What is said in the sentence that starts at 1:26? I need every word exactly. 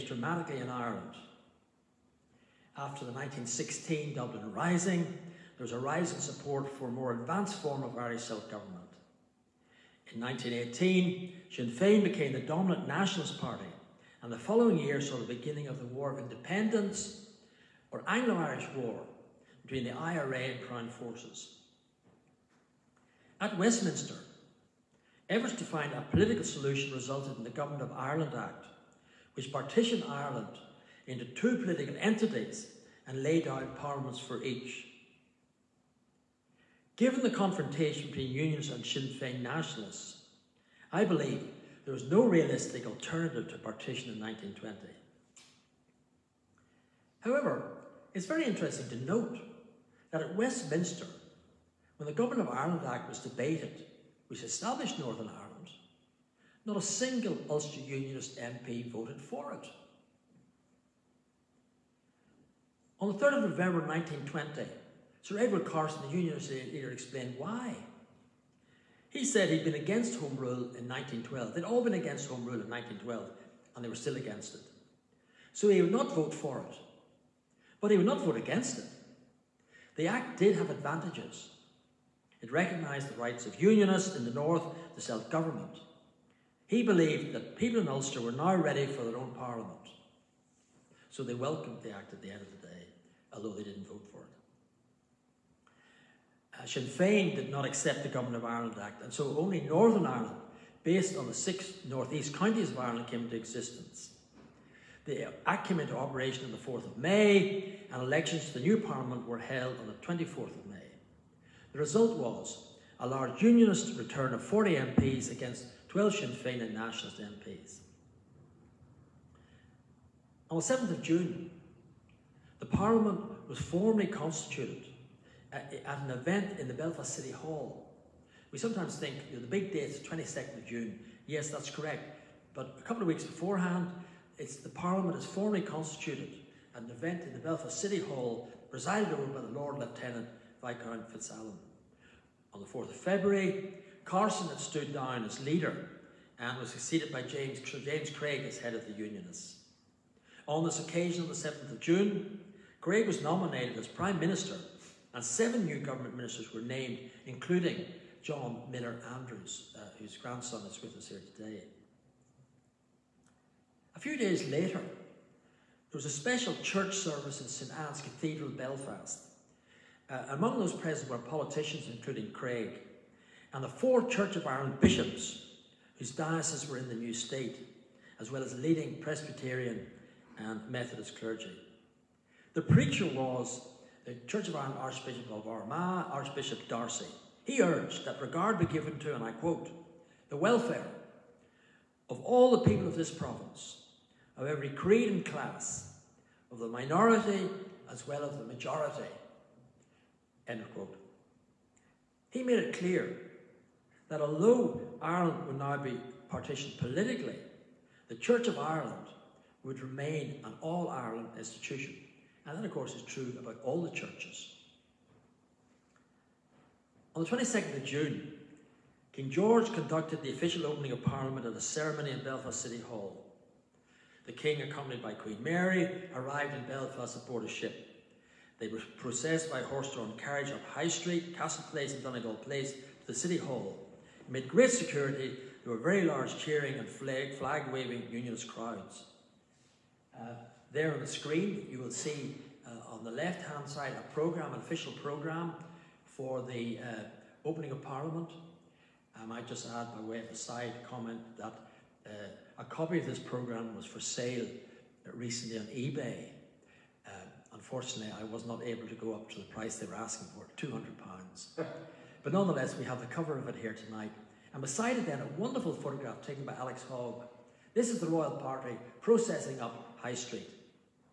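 He believed that people in Ulster were now ready for their own Parliament.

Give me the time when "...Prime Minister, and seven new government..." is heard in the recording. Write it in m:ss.
2:33.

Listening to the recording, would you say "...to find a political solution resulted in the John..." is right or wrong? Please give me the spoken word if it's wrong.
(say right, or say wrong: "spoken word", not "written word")
wrong: "Government", not "John".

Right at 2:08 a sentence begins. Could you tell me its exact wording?
We sometimes think you know, the big date is 22nd of June.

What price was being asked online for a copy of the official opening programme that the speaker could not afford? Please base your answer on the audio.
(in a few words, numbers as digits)
£200.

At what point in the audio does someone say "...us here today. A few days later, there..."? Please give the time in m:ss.
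2:40.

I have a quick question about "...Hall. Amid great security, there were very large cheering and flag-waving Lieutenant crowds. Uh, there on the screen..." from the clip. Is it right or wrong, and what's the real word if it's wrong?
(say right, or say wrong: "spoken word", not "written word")
wrong: "Unionist", not "Lieutenant".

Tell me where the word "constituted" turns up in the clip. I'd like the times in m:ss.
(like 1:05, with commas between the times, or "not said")
2:04, 2:15.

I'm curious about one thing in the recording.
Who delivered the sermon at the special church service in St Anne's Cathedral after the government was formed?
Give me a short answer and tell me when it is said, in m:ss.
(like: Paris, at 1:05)
Archbishop D'Arcy, at 3:06.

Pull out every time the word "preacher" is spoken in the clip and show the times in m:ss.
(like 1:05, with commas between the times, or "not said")
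3:02.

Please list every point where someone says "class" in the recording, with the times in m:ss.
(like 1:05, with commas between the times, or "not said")
3:15.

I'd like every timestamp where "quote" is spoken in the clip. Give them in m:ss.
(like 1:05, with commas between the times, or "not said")
3:09, 3:20.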